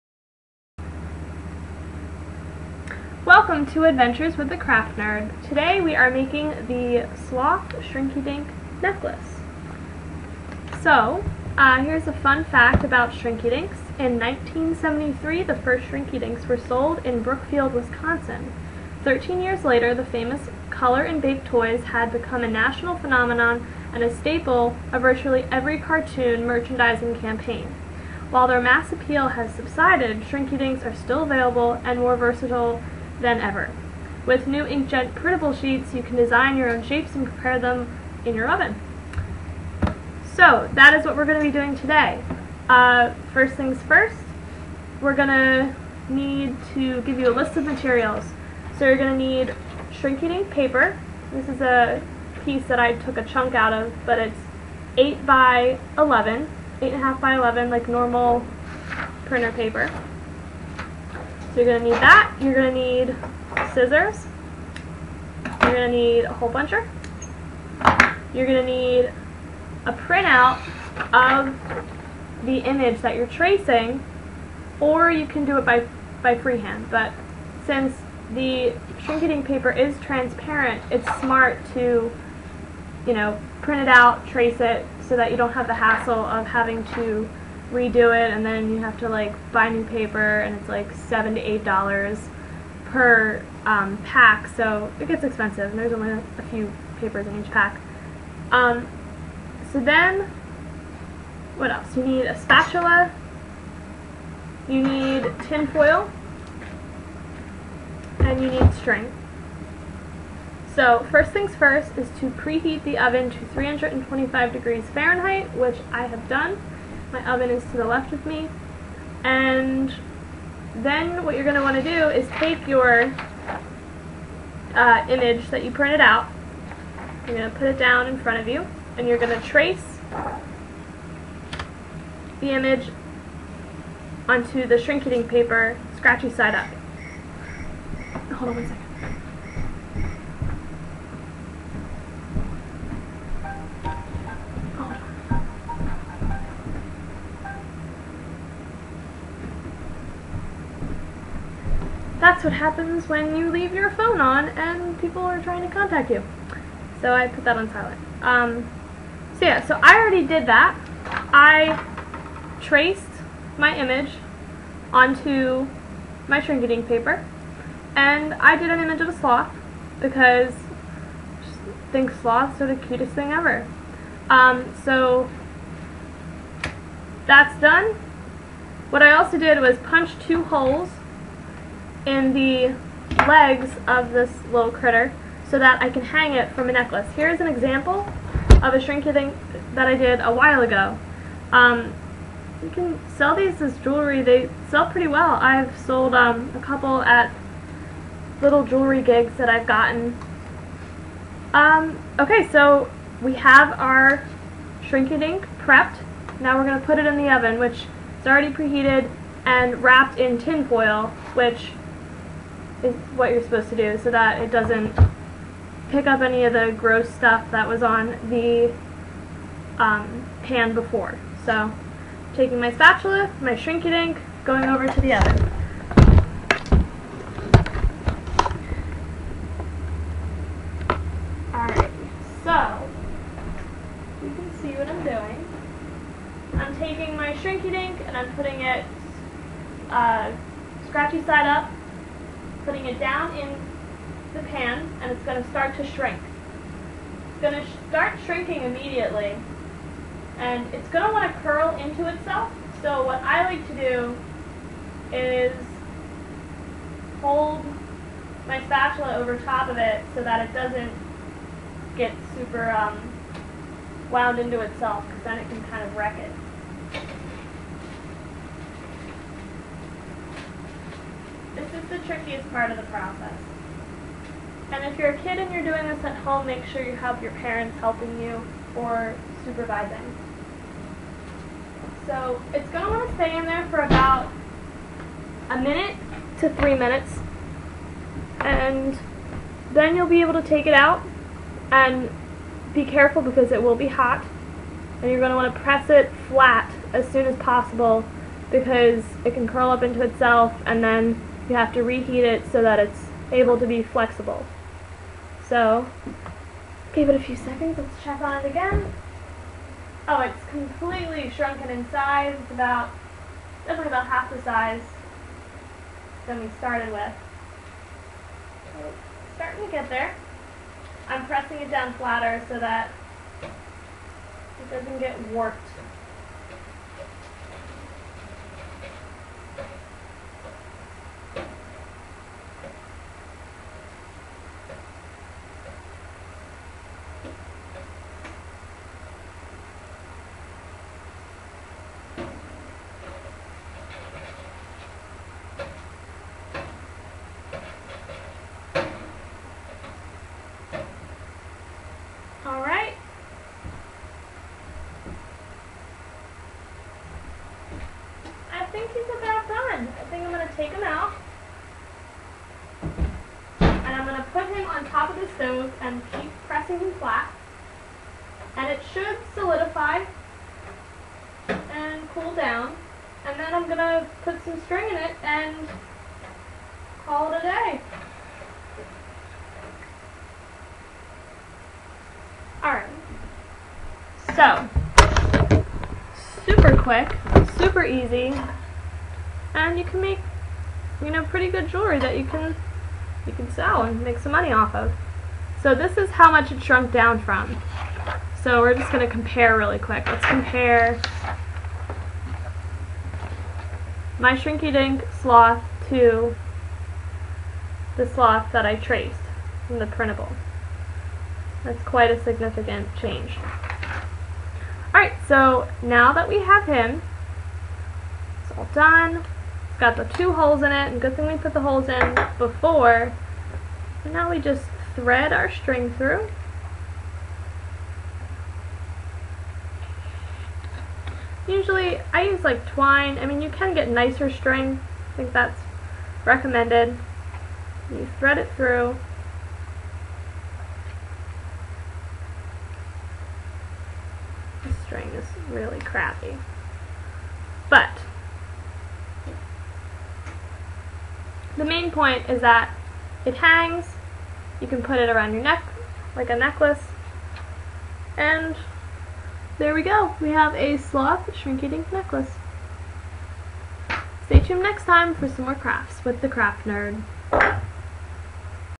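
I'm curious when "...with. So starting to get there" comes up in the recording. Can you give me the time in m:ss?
5:16.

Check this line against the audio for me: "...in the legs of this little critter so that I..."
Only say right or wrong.
right.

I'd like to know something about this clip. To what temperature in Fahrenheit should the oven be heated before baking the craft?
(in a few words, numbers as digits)
325 degrees.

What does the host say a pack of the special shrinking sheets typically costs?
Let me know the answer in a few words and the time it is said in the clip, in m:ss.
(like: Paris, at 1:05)
7 to 8 dollars, at 1:30.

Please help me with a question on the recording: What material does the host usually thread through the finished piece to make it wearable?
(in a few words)
Twine.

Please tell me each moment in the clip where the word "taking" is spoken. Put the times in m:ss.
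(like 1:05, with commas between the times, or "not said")
3:42, 3:56.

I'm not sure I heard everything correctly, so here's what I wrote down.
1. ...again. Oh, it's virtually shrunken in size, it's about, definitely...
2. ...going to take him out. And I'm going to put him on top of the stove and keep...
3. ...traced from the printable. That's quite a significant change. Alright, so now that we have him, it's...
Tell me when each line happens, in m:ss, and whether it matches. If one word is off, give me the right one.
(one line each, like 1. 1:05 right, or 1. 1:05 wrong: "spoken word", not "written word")
1. 5:08 wrong: "completely", not "virtually"
2. 6:00 right
3. 6:48 right.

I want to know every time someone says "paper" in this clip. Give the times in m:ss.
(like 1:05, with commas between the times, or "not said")
0:50, 0:59, 1:19, 1:29, 1:36, 2:15, 2:46.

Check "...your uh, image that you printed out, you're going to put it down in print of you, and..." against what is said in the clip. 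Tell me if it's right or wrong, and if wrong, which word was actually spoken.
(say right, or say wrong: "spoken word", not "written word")
wrong: "front", not "print".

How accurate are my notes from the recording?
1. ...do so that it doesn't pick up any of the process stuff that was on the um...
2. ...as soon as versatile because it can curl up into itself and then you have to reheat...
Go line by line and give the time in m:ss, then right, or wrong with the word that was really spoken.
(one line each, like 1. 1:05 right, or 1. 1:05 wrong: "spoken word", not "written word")
1. 3:33 wrong: "gross", not "process"
2. 4:56 wrong: "possible", not "versatile".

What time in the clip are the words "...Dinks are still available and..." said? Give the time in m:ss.
0:30.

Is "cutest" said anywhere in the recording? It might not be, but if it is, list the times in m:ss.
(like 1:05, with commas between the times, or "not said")
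2:52.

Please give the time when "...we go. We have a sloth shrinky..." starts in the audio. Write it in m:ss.
7:39.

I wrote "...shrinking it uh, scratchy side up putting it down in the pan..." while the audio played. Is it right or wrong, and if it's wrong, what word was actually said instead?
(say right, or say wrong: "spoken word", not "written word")
wrong: "putting", not "shrinking".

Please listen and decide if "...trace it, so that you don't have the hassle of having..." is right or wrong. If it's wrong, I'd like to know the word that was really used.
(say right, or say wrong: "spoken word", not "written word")
right.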